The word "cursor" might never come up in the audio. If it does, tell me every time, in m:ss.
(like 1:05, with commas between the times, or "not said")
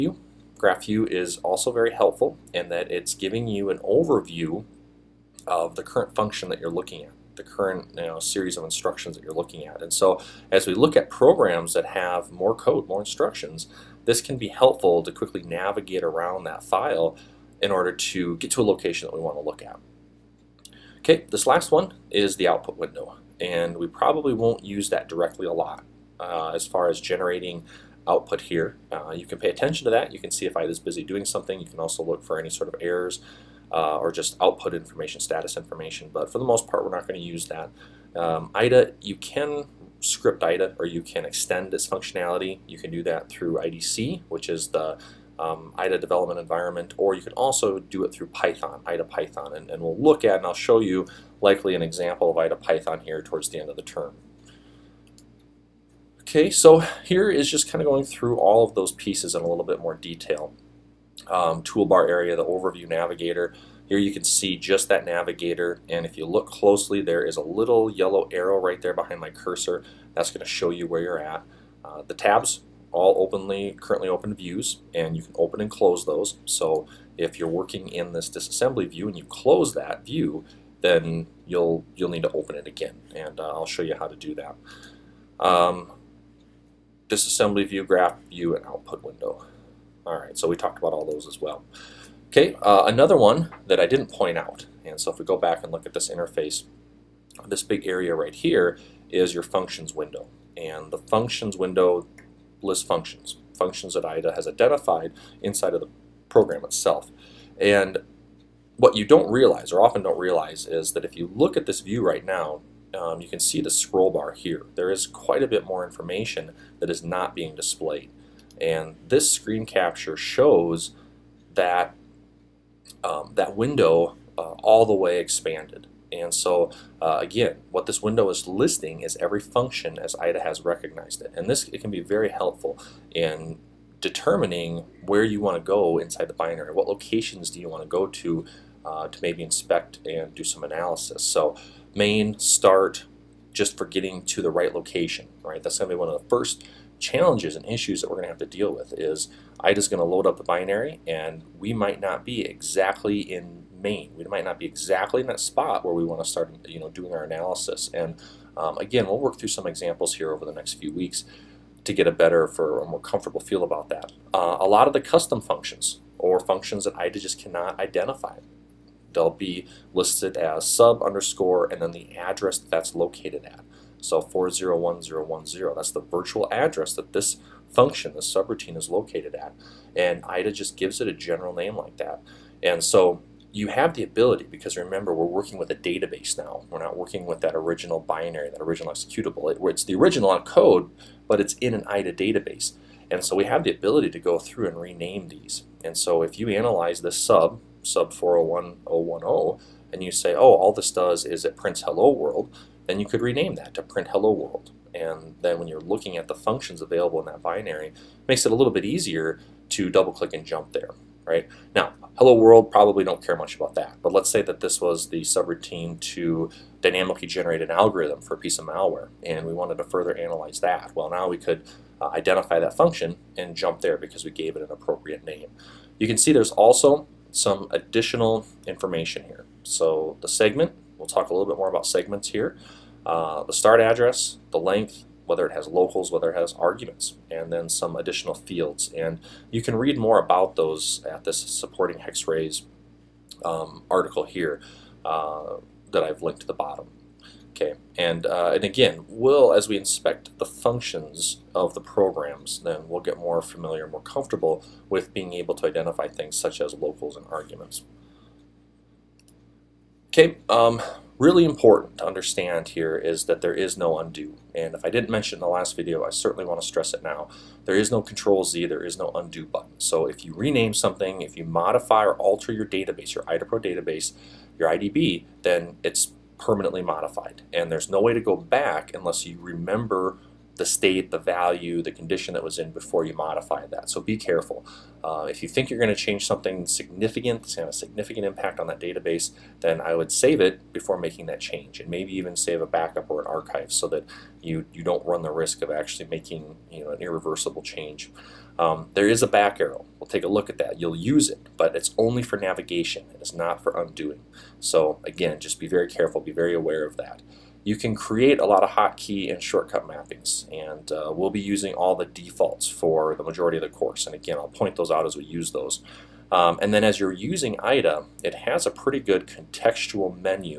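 1:09.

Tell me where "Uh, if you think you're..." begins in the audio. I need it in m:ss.
4:45.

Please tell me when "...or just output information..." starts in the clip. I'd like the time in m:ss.
0:33.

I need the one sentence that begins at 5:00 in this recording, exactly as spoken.
You'll use it, but it's only for navigation.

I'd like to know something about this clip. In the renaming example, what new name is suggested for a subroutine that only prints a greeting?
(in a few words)
print hello world.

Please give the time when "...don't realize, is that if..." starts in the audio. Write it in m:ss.
1:50.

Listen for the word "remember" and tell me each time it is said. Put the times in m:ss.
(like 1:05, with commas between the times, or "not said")
3:04, 4:39.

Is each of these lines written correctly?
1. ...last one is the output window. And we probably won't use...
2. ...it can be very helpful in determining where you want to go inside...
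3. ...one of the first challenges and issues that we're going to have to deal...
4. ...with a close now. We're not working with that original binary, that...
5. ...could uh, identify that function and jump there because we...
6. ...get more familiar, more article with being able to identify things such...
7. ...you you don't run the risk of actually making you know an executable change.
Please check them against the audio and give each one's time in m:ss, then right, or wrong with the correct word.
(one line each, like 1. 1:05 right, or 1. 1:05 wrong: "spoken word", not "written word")
1. 0:21 right
2. 2:11 right
3. 2:25 right
4. 3:05 wrong: "database", not "close"
5. 3:41 right
6. 4:13 wrong: "comfortable", not "article"
7. 4:54 wrong: "irreversible", not "executable".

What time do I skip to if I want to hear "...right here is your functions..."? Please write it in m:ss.
1:38.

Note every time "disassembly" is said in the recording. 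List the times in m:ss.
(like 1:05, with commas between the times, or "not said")
1:18, 1:27.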